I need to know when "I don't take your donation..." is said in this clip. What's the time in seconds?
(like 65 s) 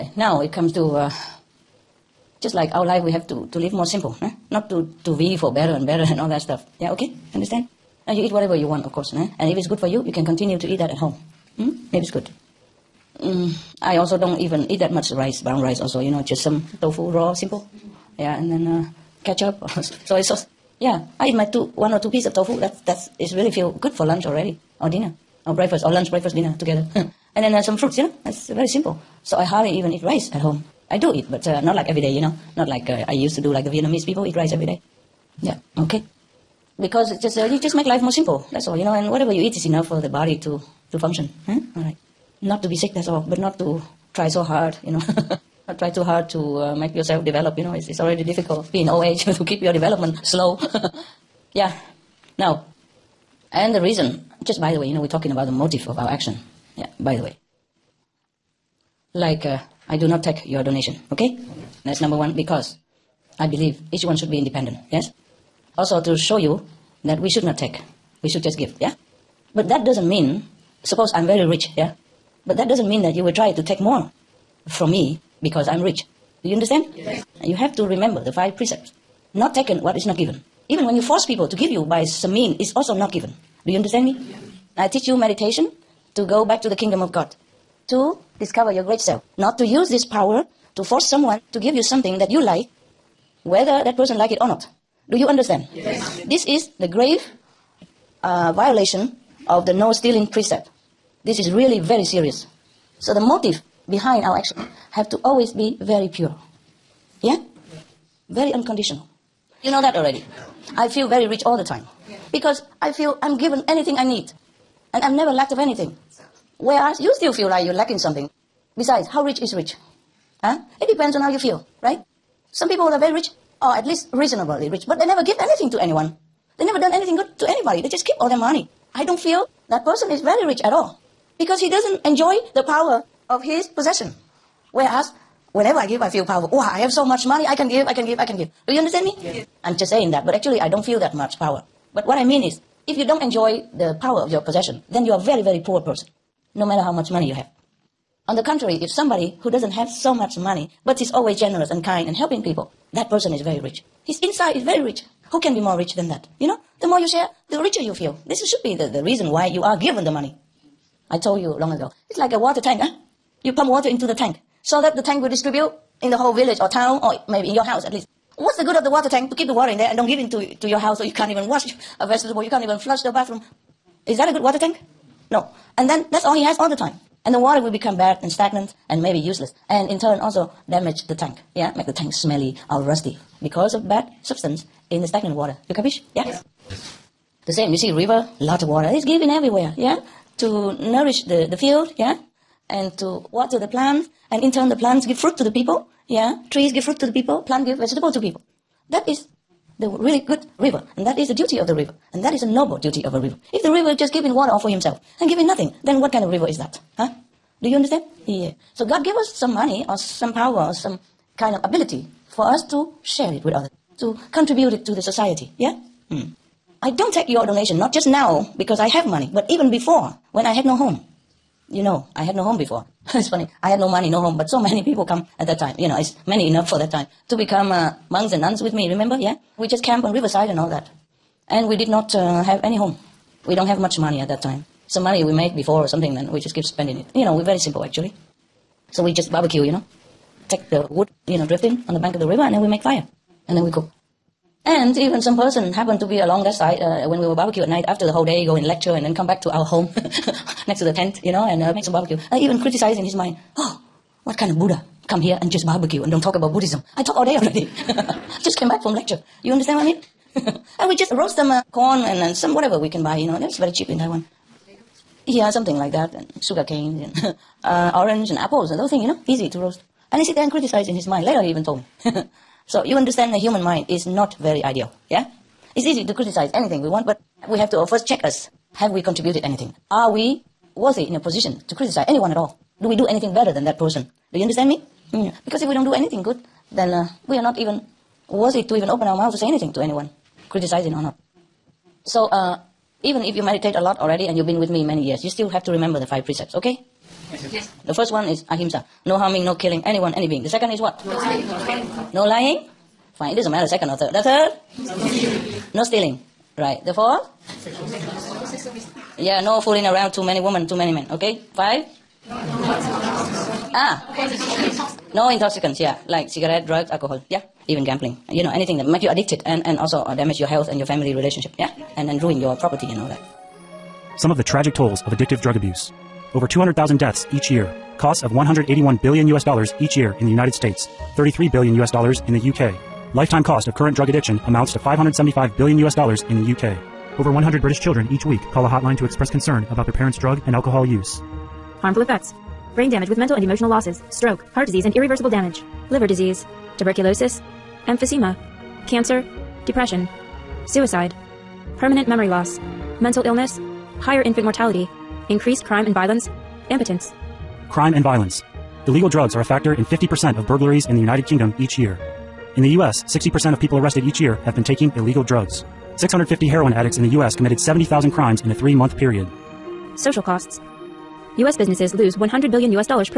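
216 s.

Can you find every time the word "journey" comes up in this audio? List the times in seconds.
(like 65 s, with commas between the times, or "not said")
not said.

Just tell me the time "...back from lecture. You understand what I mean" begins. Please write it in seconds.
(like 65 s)
258 s.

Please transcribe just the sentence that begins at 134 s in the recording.
Whereas, whenever I give, I feel powerful.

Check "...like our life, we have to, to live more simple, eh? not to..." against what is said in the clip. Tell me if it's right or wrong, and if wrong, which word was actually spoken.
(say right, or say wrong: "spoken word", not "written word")
right.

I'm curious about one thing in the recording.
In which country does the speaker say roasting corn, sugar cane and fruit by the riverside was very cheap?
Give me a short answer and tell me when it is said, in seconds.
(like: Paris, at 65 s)
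Taiwan, at 263 s.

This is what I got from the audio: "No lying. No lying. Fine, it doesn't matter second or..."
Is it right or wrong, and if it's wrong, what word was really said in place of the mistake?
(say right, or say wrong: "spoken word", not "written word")
right.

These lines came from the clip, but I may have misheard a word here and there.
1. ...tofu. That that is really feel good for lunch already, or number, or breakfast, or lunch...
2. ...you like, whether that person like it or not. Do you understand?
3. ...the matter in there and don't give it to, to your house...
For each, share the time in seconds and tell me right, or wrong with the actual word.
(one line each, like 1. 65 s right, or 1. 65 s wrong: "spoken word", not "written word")
1. 22 s wrong: "dinner", not "number"
2. 92 s right
3. 169 s wrong: "water", not "matter".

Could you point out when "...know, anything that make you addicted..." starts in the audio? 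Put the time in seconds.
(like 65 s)
318 s.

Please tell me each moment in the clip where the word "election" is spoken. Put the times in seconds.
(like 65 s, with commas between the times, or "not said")
not said.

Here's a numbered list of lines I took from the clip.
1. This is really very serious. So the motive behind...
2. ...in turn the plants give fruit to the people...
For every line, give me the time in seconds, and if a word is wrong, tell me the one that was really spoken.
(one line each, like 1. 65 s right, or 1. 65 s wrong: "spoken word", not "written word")
1. 101 s right
2. 194 s right.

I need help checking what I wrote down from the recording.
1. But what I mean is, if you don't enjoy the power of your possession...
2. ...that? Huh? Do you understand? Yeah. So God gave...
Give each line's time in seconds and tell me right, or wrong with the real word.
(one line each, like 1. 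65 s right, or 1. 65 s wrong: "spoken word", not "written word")
1. 141 s right
2. 206 s right.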